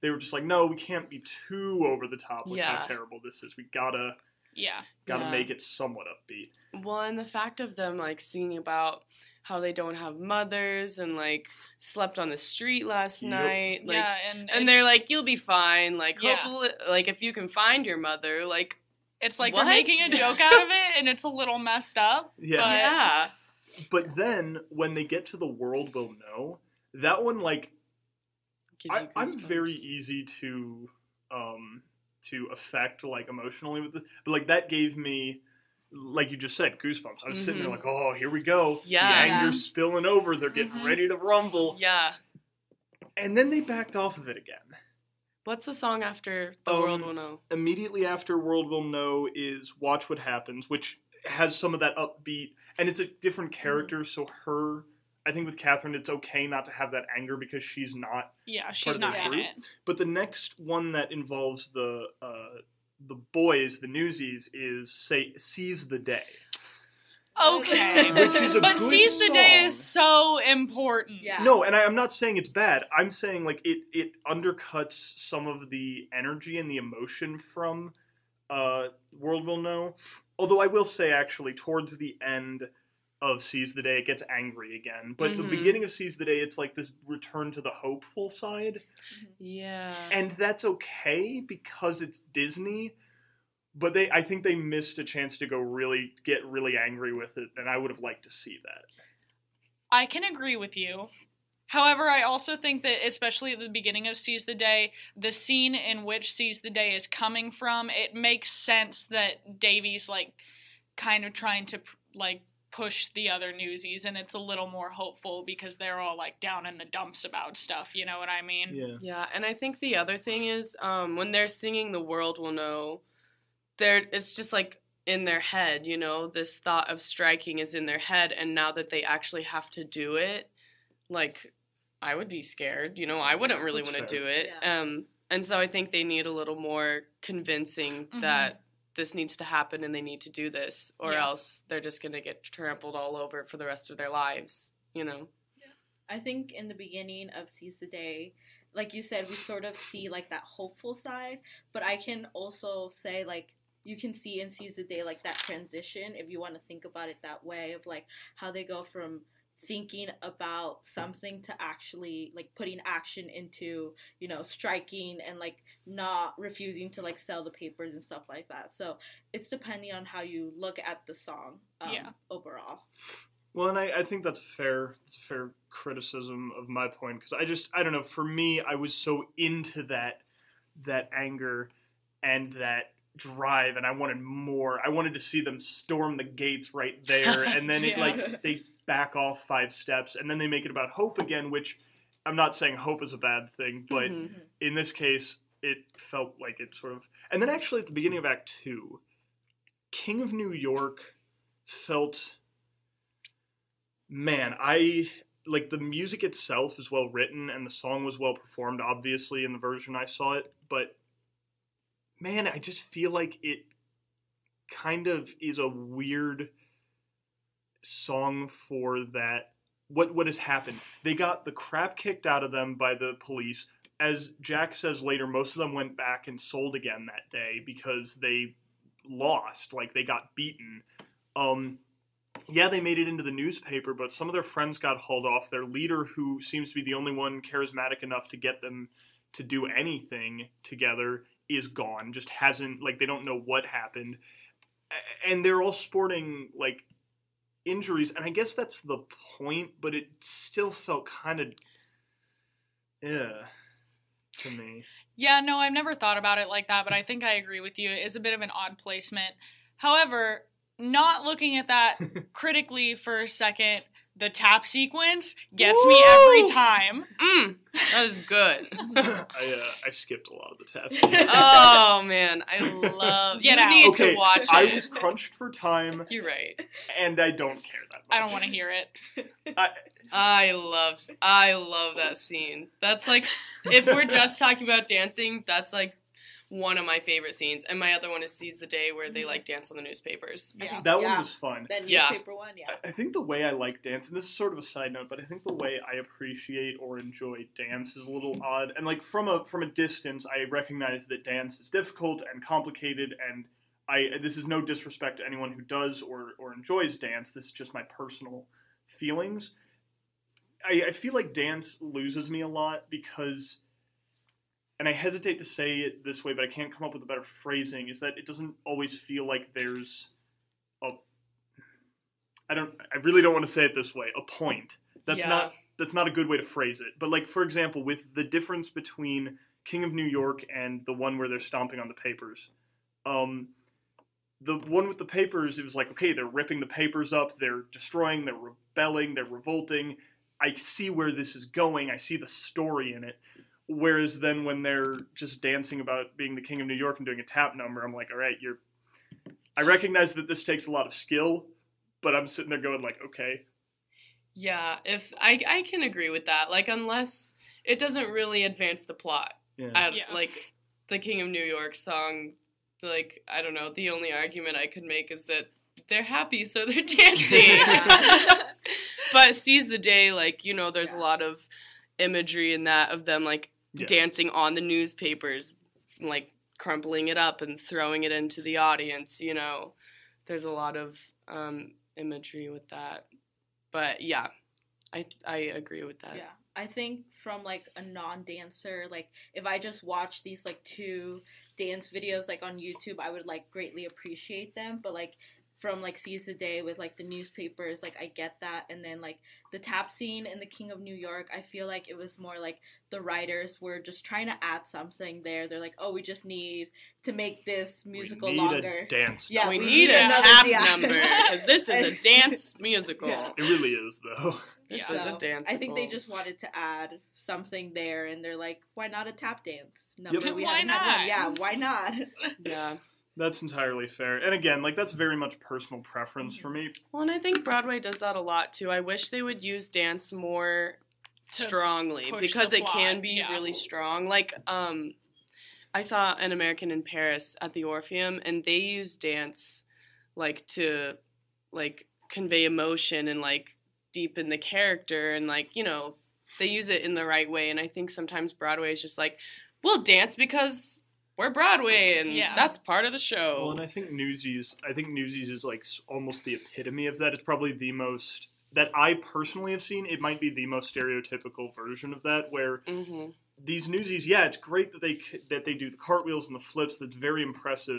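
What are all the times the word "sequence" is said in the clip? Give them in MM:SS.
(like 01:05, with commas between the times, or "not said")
04:24, 04:30.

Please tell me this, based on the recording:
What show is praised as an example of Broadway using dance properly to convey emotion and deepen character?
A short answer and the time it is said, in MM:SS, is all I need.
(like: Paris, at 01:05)
An American in Paris, at 07:16.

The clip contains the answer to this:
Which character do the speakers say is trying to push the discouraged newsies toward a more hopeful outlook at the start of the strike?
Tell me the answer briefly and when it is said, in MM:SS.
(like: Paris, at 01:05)
Davey, at 01:49.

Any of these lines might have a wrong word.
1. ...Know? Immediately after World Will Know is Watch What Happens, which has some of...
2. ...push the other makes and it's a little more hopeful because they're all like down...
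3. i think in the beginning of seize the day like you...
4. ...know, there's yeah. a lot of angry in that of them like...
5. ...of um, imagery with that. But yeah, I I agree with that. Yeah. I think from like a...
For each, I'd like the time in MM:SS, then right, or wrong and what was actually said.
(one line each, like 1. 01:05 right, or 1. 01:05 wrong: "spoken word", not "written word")
1. 00:47 right
2. 01:52 wrong: "newsies", not "makes"
3. 02:26 right
4. 06:10 wrong: "imagery", not "angry"
5. 06:20 right.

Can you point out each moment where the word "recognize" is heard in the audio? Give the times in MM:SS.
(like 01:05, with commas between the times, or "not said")
05:00, 05:49.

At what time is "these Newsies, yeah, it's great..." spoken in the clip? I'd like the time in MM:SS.
07:43.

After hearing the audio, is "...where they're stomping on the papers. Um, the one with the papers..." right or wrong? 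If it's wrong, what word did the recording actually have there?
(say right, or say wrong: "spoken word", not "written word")
right.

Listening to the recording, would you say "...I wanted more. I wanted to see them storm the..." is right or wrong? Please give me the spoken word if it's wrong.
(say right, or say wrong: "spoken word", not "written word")
right.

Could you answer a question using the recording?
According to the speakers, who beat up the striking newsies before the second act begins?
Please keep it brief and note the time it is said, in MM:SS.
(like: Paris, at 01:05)
The police, at 03:42.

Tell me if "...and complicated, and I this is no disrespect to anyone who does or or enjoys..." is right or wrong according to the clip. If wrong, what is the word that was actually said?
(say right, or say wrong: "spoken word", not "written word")
right.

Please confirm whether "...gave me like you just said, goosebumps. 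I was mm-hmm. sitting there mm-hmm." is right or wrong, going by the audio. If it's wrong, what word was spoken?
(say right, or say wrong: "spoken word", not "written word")
right.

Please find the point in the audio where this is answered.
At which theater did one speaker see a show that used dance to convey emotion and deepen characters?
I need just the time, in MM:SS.
07:17.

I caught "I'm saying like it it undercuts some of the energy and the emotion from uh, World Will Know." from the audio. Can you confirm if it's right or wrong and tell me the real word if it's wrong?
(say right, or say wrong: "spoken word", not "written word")
right.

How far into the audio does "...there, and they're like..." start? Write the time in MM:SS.
06:57.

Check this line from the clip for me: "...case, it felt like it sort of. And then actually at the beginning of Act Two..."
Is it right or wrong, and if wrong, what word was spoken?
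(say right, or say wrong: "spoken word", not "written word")
right.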